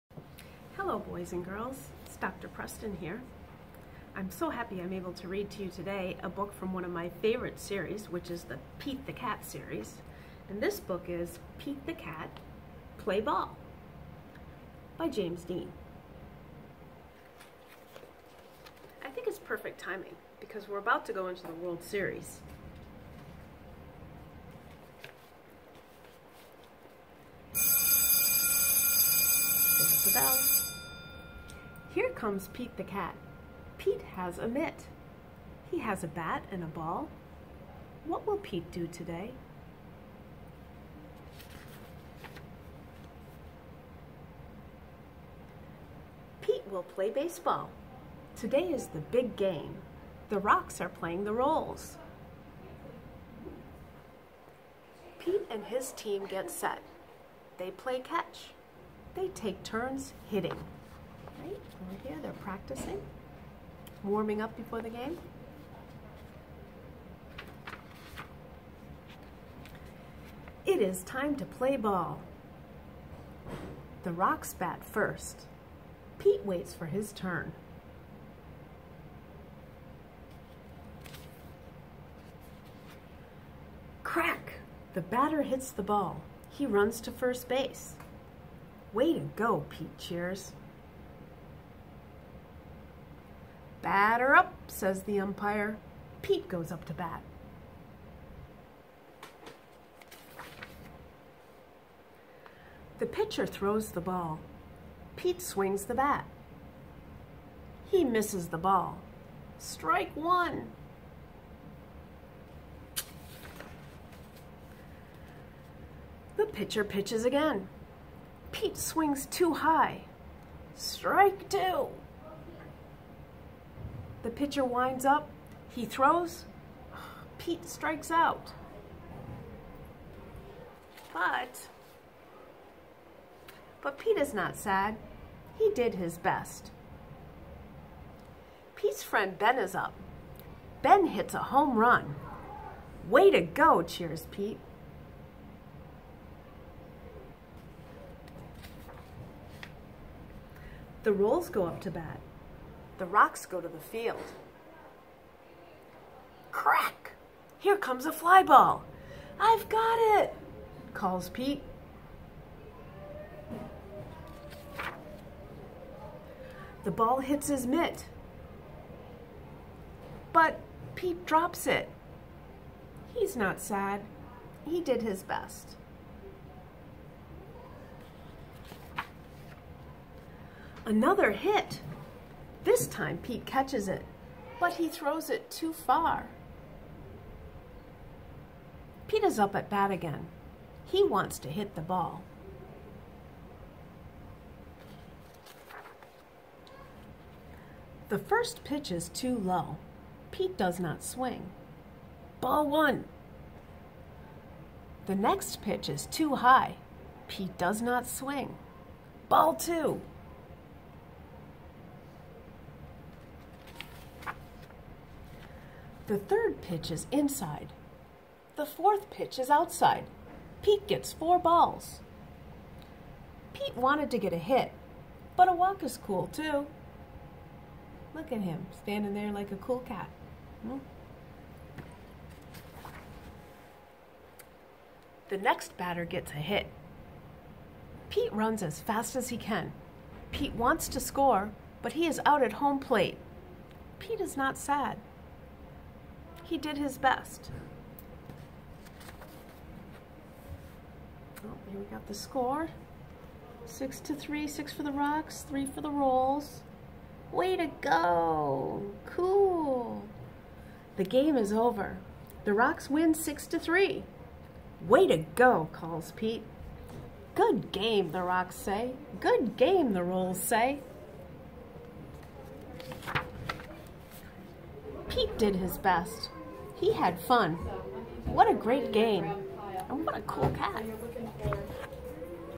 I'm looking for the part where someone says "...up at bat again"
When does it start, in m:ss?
3:09.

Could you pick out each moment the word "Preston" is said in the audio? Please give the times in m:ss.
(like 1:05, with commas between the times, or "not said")
0:02.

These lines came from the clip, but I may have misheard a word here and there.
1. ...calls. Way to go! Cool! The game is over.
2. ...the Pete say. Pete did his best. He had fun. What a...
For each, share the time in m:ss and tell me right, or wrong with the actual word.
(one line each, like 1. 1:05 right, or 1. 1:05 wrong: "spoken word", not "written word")
1. 4:15 wrong: "rolls", not "calls"
2. 4:29 wrong: "Rolls", not "Pete".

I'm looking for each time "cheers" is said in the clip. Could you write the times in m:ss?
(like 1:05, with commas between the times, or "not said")
1:29, 2:23.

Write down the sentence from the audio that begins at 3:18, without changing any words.
The first pitch is too low.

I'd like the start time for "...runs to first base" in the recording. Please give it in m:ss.
1:26.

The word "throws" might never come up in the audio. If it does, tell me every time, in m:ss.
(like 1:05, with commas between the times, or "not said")
1:43, 2:05, 3:04.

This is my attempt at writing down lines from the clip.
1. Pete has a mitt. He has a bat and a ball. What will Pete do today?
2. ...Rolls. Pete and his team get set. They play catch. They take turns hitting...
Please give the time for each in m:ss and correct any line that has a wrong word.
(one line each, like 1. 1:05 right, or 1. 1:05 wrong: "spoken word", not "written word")
1. 0:33 right
2. 0:51 right.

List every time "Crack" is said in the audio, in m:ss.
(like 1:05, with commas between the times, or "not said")
1:24, 2:36.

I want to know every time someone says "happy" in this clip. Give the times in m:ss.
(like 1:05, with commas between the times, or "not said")
0:04.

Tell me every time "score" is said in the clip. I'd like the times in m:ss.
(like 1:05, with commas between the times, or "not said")
4:00, 4:12.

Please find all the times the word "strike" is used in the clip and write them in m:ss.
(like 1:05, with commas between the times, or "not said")
1:49, 2:00, 2:07.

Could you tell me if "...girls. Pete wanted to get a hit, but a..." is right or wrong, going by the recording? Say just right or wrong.
wrong.